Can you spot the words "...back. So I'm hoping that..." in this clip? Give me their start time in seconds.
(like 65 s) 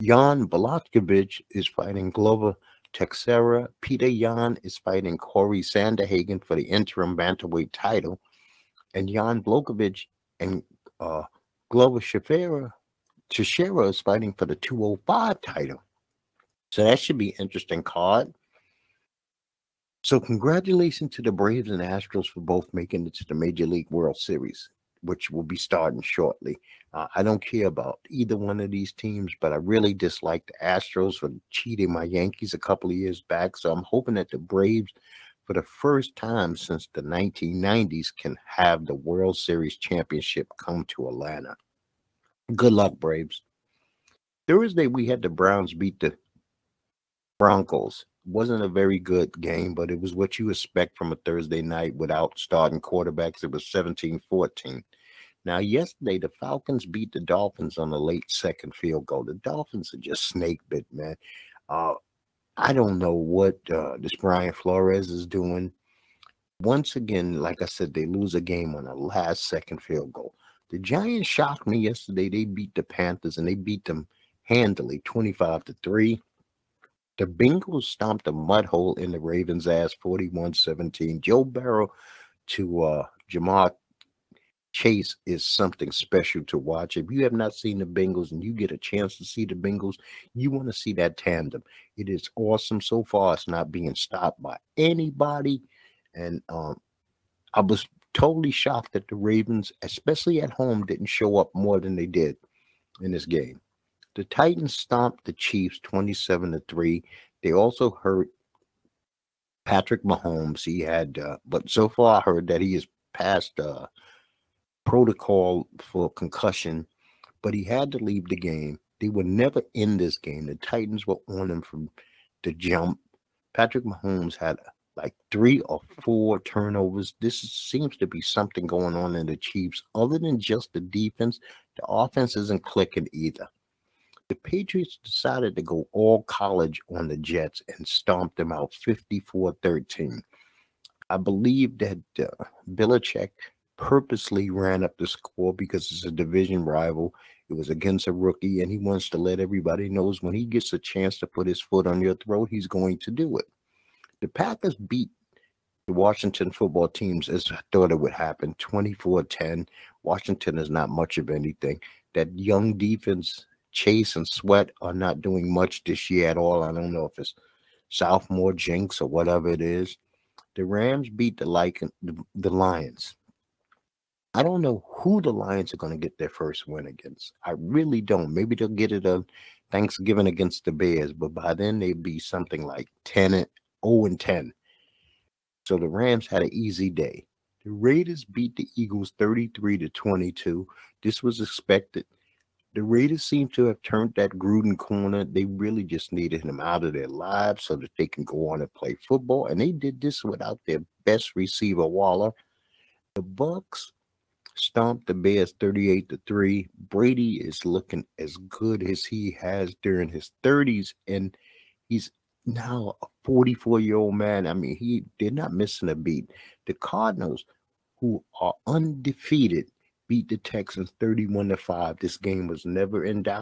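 33 s.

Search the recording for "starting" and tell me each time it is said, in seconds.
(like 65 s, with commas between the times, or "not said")
25 s, 52 s.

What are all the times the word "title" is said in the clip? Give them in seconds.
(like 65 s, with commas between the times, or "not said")
7 s, 15 s.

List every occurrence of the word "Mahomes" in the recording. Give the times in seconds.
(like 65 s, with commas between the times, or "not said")
110 s, 123 s.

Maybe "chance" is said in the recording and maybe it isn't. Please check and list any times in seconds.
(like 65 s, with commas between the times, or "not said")
88 s, 150 s.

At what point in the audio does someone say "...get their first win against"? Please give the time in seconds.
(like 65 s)
175 s.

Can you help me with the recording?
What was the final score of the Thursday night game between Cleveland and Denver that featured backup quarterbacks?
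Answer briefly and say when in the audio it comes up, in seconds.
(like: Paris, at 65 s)
17-14, at 53 s.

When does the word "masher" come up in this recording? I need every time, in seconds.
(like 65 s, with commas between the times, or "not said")
not said.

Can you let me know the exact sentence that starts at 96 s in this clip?
And um, I was totally shocked that the Ravens, especially at home, didn't show up more than they did in this game.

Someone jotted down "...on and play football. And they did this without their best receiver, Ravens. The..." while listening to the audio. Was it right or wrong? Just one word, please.
wrong.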